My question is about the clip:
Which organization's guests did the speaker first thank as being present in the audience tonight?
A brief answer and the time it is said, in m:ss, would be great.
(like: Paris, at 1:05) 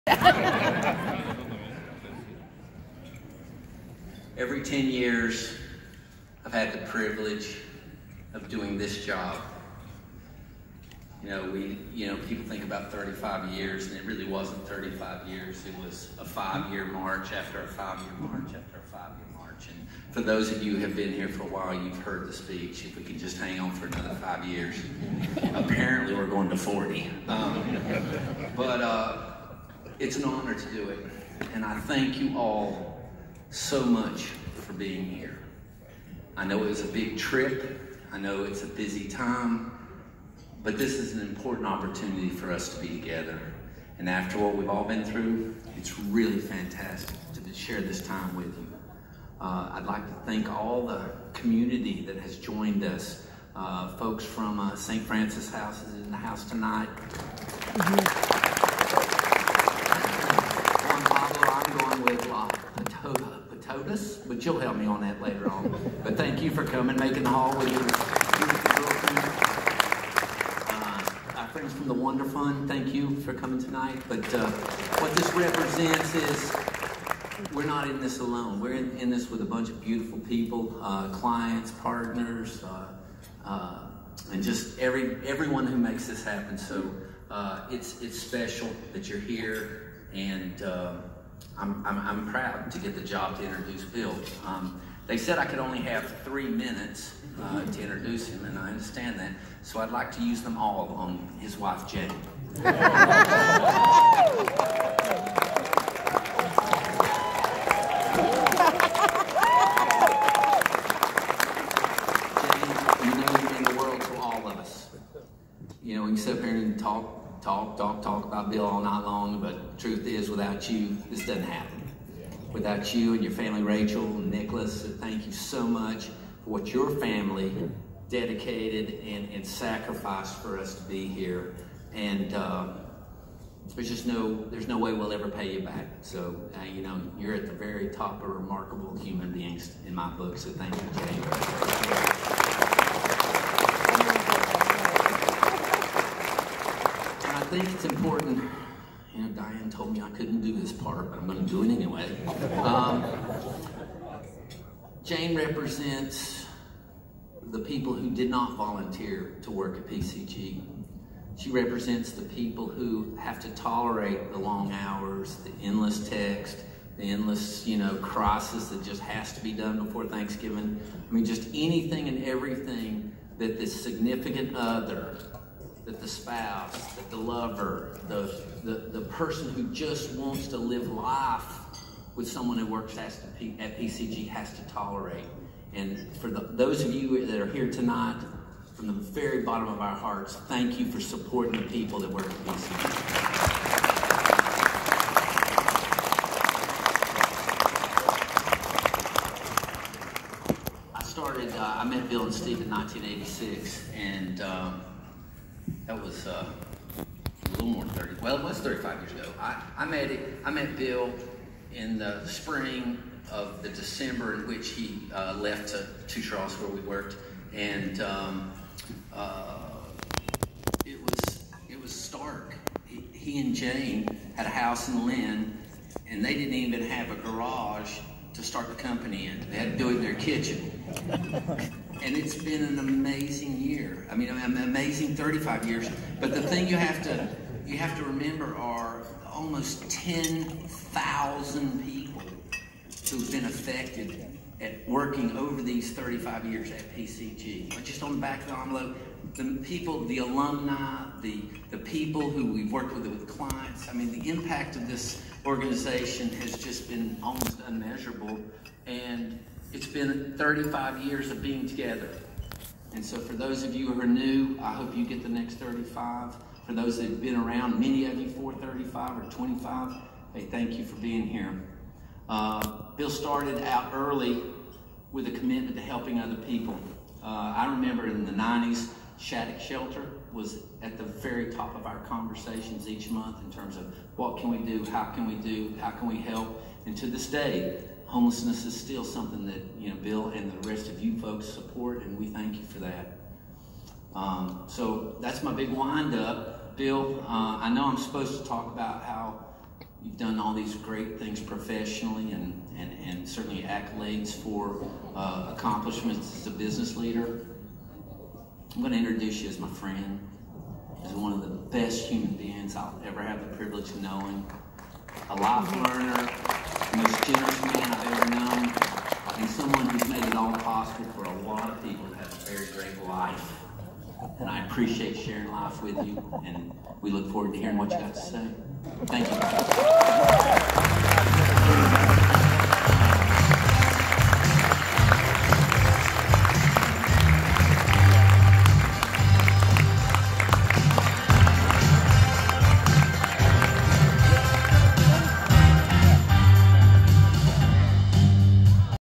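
St. Francis House, at 0:54.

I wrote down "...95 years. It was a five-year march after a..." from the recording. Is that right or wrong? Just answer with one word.
wrong.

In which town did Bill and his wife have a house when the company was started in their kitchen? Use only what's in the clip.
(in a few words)
Lynn.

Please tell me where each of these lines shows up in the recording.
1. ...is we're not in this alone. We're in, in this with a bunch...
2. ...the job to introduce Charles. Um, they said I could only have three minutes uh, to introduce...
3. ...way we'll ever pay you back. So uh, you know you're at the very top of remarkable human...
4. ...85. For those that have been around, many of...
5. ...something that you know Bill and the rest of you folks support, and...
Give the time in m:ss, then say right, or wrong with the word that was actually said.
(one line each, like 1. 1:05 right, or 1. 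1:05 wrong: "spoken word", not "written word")
1. 1:16 right
2. 1:32 wrong: "Bill", not "Charles"
3. 2:14 right
4. 4:25 wrong: "35", not "85"
5. 4:49 right.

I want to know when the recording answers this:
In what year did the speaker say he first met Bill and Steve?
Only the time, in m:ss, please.
3:22.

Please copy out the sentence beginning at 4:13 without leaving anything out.
I mean, the impact of this organization has just been almost unmeasurable.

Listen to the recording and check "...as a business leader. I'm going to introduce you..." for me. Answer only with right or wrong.
right.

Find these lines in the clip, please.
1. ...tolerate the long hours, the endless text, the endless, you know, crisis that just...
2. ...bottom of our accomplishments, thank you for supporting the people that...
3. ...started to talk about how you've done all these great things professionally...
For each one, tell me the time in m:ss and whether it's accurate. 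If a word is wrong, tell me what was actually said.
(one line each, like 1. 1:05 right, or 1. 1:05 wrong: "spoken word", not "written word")
1. 2:43 right
2. 3:09 wrong: "hearts", not "accomplishments"
3. 4:57 wrong: "supposed", not "started".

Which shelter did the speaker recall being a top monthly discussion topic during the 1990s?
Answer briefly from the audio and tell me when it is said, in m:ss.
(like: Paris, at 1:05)
Shattuck Shelter, at 4:39.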